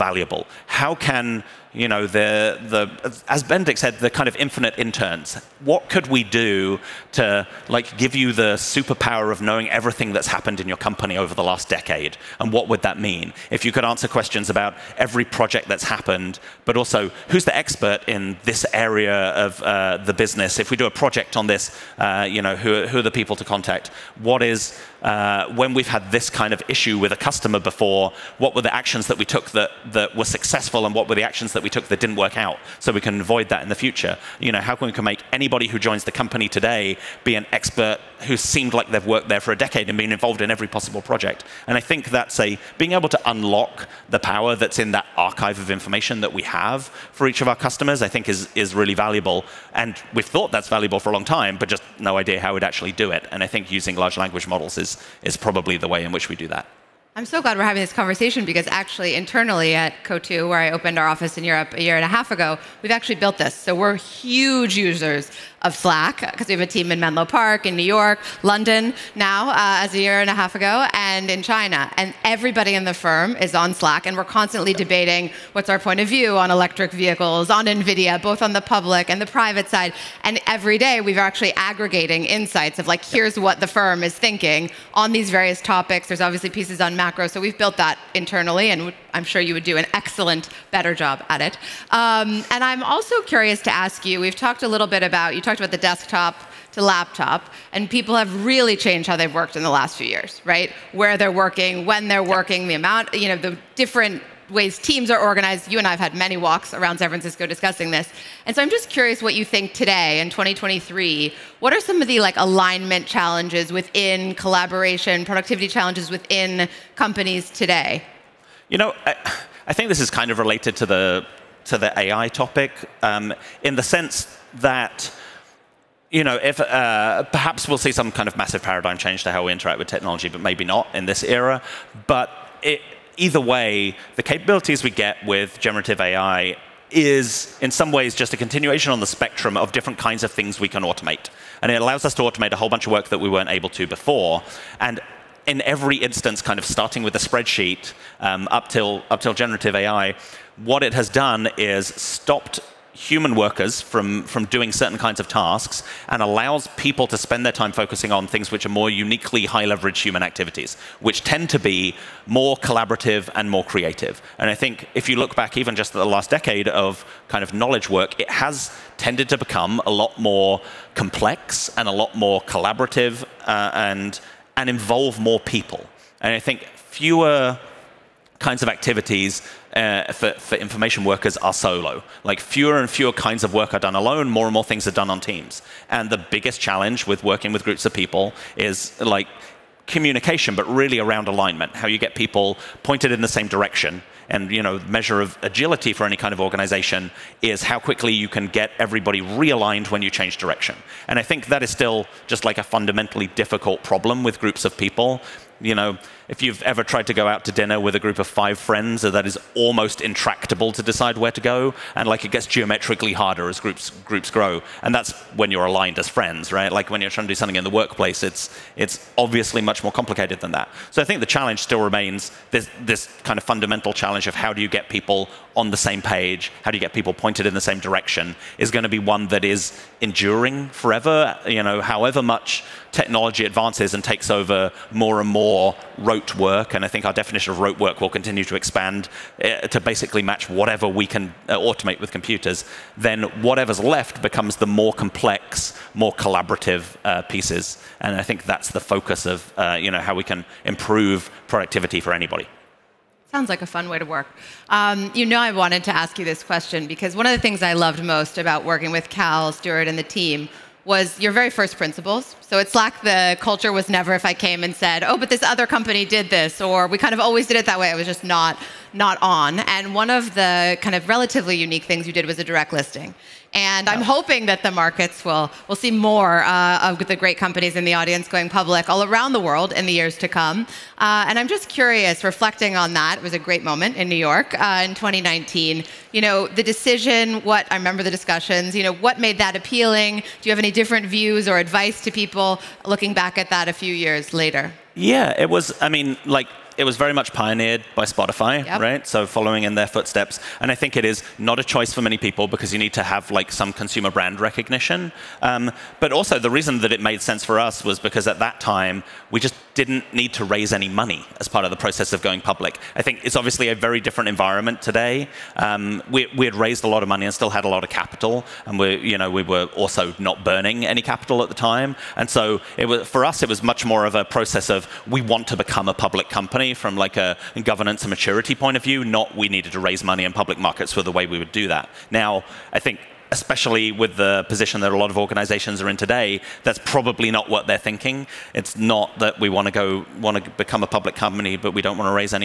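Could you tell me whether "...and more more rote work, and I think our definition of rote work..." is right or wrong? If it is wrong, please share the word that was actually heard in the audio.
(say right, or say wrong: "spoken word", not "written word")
right.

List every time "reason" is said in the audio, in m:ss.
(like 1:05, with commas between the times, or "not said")
5:06.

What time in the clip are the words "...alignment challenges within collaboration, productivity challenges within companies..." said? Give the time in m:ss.
1:52.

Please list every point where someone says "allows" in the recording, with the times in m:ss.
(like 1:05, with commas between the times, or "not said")
2:21, 2:36.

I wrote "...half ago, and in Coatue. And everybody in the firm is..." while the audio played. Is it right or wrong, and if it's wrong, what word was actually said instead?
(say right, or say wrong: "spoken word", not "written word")
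wrong: "China", not "Coatue".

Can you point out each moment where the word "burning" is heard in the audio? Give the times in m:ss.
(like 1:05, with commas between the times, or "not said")
5:20.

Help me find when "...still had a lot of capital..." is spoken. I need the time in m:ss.
5:17.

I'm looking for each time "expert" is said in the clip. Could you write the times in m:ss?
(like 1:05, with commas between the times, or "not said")
0:17, 0:37.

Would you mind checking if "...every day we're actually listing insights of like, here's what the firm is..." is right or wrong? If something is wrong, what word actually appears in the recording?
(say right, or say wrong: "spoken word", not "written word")
wrong: "aggregating", not "listing".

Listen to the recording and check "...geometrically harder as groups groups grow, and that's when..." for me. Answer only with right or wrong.
right.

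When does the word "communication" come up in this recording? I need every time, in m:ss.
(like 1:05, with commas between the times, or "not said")
3:09.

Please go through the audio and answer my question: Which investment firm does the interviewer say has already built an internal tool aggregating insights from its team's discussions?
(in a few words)
Coatue.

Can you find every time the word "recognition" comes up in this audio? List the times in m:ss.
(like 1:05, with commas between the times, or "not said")
5:04.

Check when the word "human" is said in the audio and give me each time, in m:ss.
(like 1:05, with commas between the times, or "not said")
2:32, 2:39.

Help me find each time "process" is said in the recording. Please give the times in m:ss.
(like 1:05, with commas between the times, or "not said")
5:11, 5:24.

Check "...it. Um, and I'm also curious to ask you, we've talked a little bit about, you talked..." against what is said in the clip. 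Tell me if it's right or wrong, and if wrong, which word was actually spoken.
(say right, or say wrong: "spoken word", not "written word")
right.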